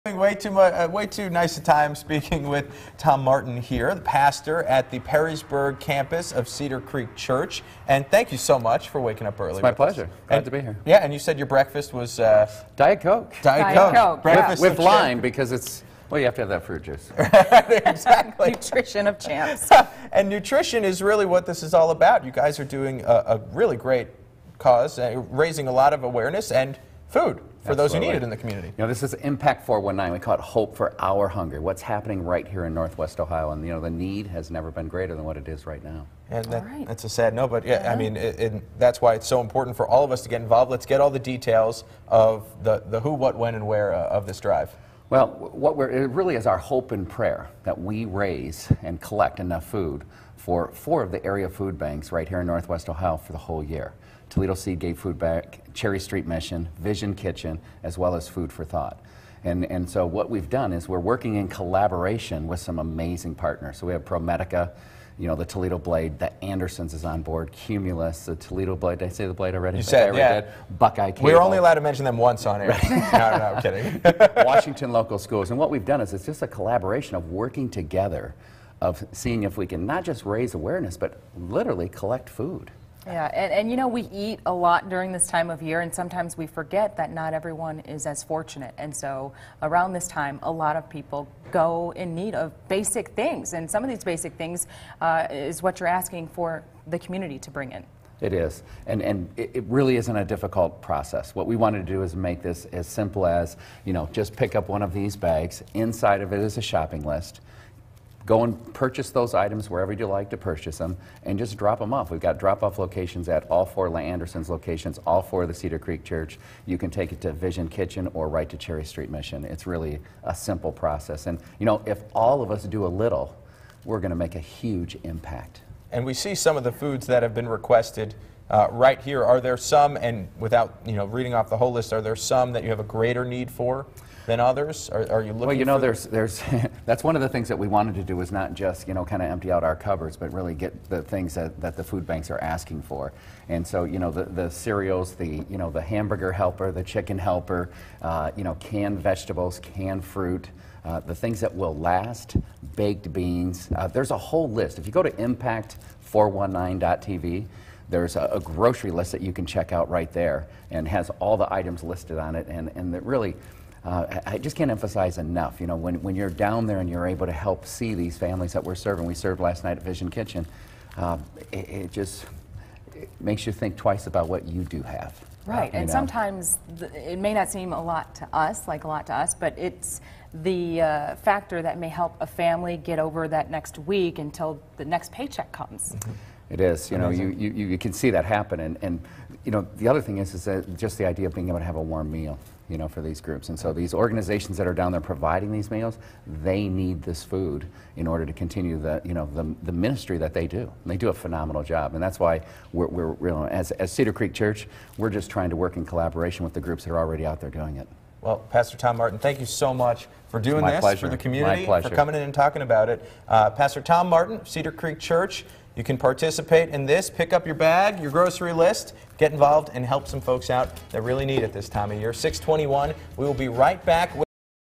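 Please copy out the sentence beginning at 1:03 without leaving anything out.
So we have ProMedica, you know, the Toledo Blade, the Andersons is on board, Cumulus, the Toledo Blade.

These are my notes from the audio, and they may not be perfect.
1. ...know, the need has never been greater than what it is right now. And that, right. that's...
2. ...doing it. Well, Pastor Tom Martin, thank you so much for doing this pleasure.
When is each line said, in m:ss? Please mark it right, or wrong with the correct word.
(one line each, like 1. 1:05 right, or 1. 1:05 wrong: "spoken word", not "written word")
1. 0:33 right
2. 3:27 right.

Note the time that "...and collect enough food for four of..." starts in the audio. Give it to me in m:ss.
0:48.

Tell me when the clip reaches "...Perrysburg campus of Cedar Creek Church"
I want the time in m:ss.
0:05.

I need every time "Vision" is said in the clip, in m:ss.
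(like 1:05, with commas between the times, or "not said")
0:56, 1:57, 2:49.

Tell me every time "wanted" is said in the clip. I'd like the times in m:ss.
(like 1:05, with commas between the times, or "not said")
1:41, 2:17.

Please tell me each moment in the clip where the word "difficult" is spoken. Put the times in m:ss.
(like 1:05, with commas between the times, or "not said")
1:40.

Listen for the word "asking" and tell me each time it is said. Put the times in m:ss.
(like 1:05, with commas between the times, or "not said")
1:35, 2:22.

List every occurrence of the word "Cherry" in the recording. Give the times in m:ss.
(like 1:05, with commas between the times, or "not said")
0:55, 1:58.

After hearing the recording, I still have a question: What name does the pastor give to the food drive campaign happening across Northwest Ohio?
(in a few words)
Hope for Our Hunger.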